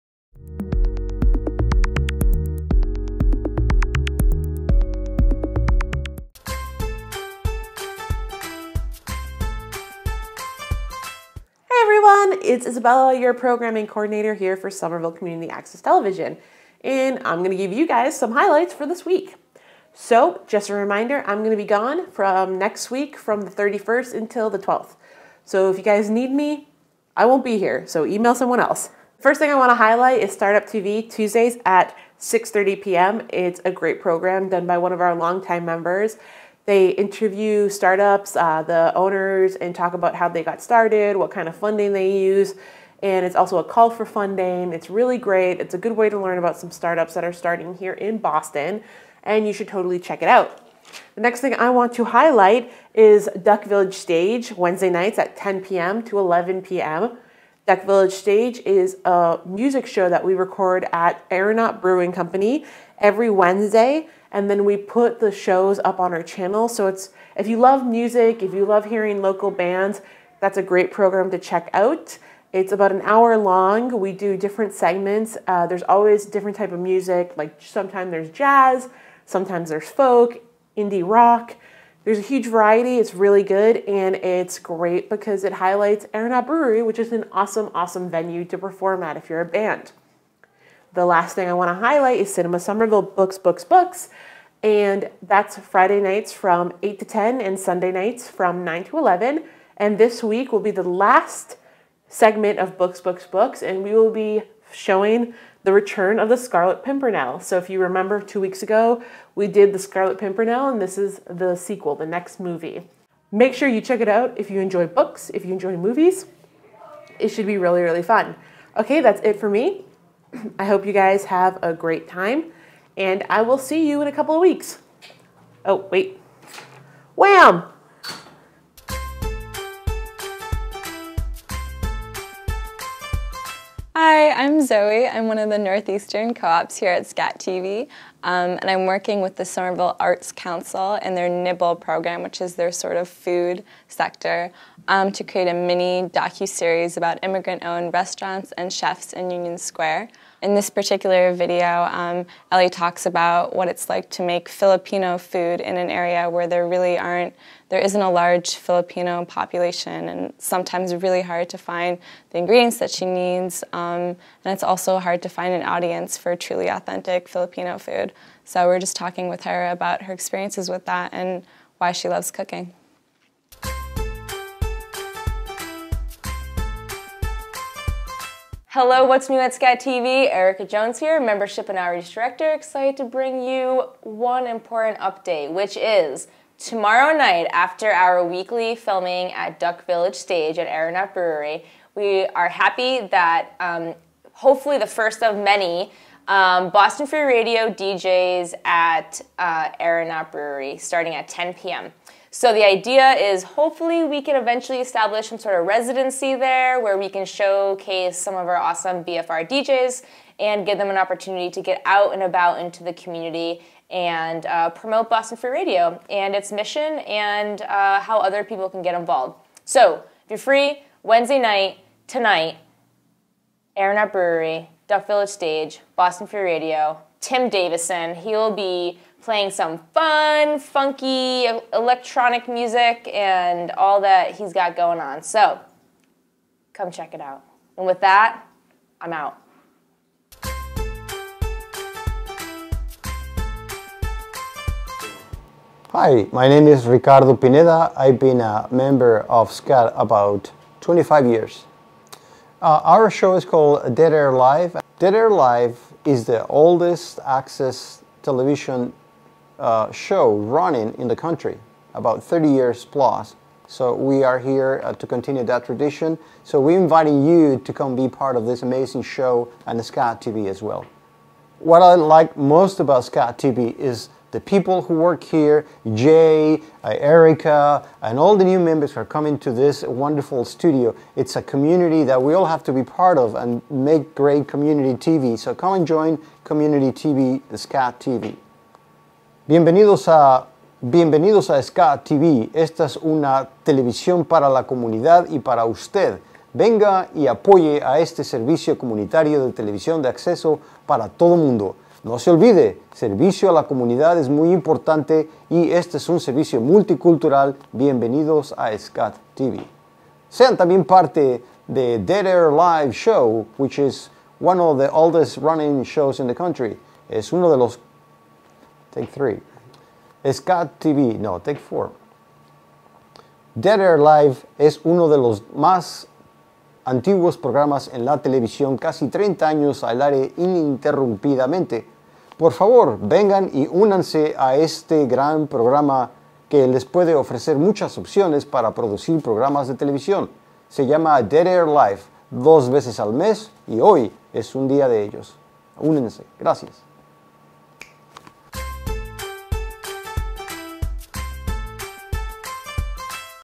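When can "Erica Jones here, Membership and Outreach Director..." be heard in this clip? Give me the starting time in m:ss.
3:00.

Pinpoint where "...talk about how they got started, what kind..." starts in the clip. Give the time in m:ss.
0:39.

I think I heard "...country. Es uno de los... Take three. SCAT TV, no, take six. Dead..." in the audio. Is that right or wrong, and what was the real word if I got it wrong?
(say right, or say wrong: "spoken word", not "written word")
wrong: "four", not "six".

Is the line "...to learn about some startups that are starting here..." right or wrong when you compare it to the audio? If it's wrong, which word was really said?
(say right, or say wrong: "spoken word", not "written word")
right.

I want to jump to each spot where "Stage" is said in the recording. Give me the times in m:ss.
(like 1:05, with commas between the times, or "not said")
0:53, 0:58, 3:10, 3:45.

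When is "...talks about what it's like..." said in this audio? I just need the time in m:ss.
2:32.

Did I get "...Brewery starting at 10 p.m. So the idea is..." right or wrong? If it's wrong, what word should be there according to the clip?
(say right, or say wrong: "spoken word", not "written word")
right.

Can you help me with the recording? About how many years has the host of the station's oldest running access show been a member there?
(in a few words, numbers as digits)
25.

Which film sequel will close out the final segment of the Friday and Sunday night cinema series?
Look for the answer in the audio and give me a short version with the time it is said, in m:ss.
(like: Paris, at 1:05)
The Return of the Scarlet Pimpernel, at 1:45.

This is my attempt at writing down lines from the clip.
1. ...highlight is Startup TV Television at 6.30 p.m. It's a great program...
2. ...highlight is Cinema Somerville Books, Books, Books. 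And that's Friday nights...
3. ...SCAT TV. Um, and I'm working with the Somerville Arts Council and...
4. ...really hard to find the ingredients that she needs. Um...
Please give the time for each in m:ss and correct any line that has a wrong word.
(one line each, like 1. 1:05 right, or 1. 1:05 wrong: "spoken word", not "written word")
1. 0:29 wrong: "Tuesdays", not "Television"
2. 1:31 right
3. 2:17 right
4. 2:40 right.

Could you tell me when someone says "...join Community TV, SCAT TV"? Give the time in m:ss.
4:45.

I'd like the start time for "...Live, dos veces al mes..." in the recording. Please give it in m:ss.
5:41.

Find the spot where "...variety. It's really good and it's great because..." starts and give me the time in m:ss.
1:22.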